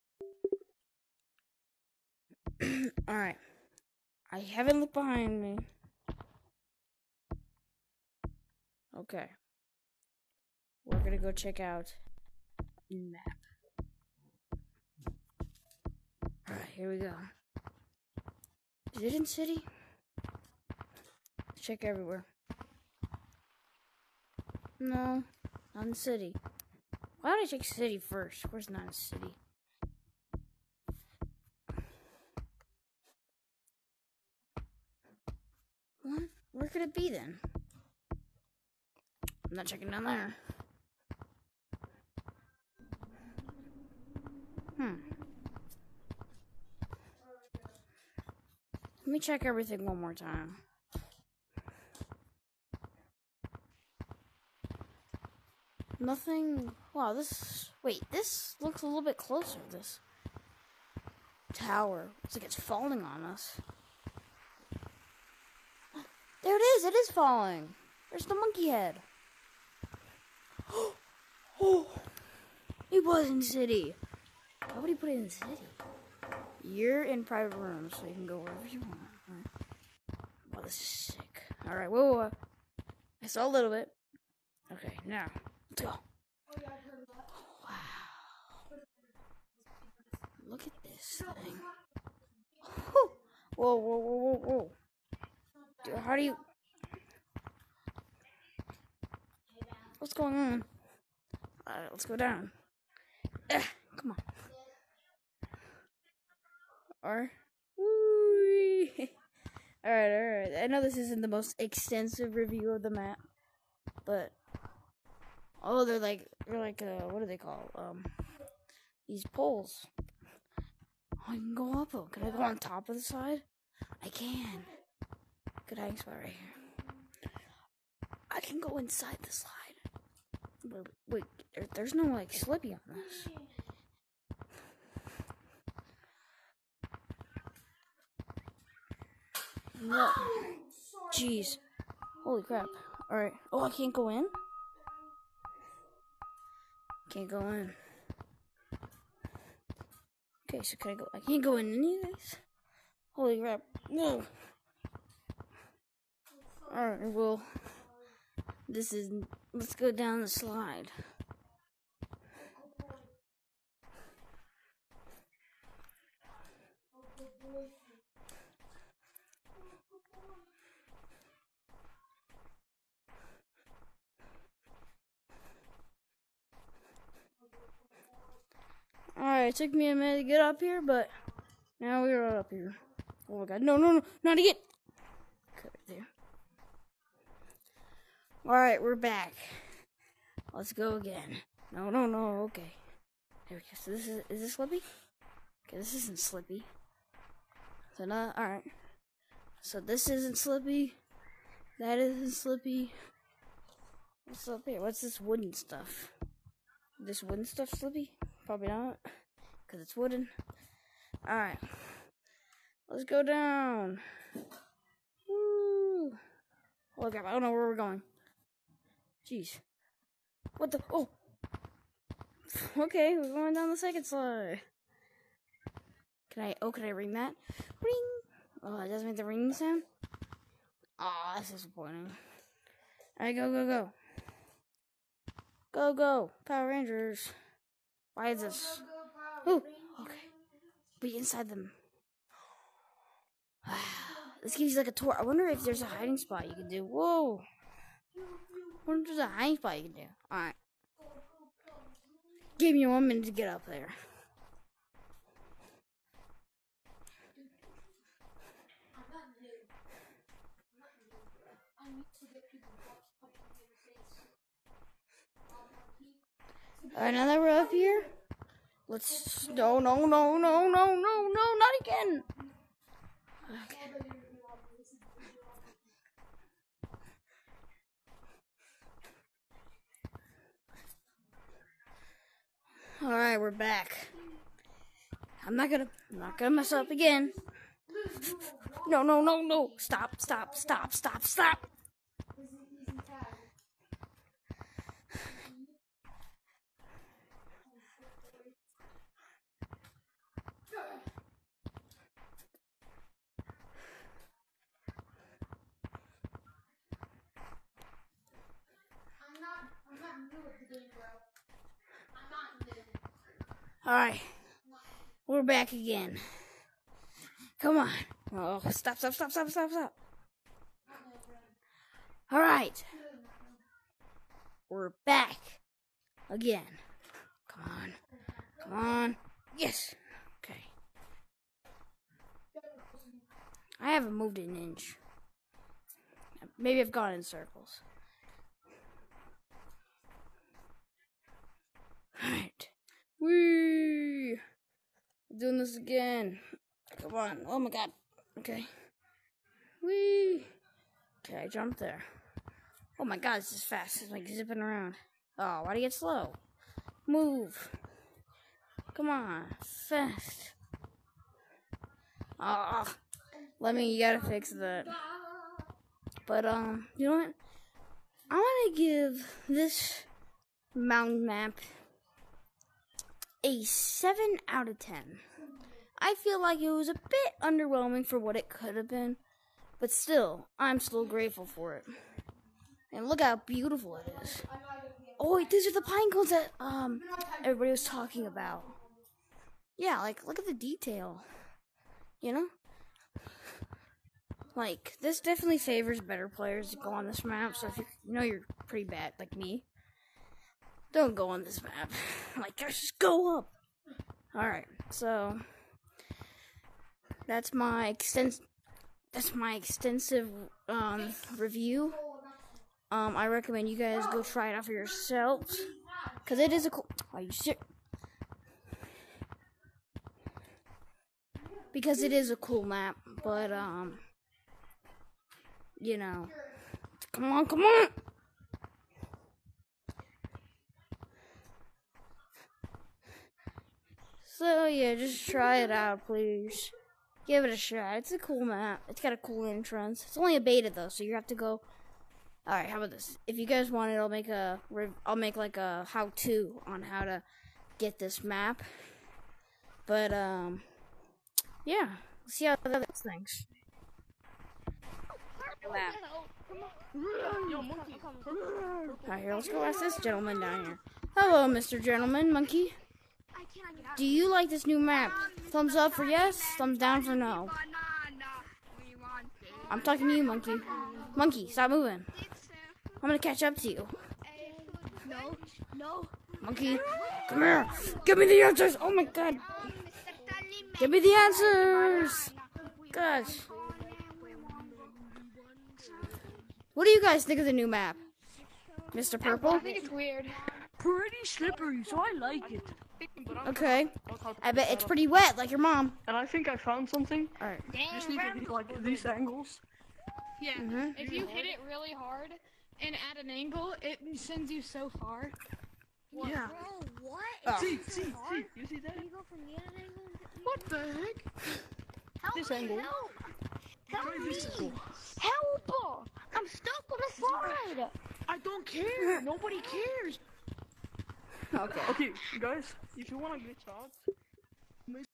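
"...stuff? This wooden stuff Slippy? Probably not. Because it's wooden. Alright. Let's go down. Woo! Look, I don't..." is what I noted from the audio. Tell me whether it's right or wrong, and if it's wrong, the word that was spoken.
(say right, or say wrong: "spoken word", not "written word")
right.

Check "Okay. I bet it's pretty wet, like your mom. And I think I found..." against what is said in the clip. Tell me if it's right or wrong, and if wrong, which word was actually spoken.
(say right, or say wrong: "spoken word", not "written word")
right.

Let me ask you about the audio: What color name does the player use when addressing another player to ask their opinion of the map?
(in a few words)
purple.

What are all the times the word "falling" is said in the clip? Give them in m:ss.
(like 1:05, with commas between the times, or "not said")
1:02, 1:07.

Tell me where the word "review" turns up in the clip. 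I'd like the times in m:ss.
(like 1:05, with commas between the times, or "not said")
1:52, 6:51.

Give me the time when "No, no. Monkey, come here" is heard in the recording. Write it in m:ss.
7:55.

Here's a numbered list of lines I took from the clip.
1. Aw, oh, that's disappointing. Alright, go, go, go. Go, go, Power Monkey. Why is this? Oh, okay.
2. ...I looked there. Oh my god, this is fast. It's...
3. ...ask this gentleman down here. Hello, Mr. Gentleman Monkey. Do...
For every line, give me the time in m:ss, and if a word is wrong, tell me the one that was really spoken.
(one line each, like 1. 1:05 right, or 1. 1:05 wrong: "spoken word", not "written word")
1. 3:50 wrong: "Rangers", not "Monkey"
2. 5:51 wrong: "jumped", not "looked"
3. 7:39 right.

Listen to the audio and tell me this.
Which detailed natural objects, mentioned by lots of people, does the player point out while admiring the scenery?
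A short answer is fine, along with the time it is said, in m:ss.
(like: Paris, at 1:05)
pine cones, at 6:25.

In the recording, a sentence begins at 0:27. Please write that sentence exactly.
Why don't I check city first?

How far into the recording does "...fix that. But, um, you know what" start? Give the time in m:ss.
6:04.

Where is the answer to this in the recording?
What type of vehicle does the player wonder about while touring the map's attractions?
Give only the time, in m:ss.
4:09.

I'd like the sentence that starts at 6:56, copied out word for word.
Cause it is a cool Are oh, you sure?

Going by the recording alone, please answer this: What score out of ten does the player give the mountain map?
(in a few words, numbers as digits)
7.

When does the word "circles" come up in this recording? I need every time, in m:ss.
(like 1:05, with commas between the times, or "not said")
5:37.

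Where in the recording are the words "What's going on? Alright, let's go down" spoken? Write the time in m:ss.
1:40.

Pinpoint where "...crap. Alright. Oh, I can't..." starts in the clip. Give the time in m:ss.
2:22.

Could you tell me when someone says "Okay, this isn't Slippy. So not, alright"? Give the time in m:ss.
3:15.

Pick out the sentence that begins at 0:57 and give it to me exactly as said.
Wait, this looks a little bit closer.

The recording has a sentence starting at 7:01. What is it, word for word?
Because it is a cool map, but um you know.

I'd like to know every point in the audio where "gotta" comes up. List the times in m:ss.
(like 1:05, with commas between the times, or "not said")
6:03.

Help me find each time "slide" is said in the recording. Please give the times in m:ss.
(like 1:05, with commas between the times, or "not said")
2:09, 2:40, 3:44, 8:37.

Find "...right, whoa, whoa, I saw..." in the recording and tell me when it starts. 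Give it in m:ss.
1:21.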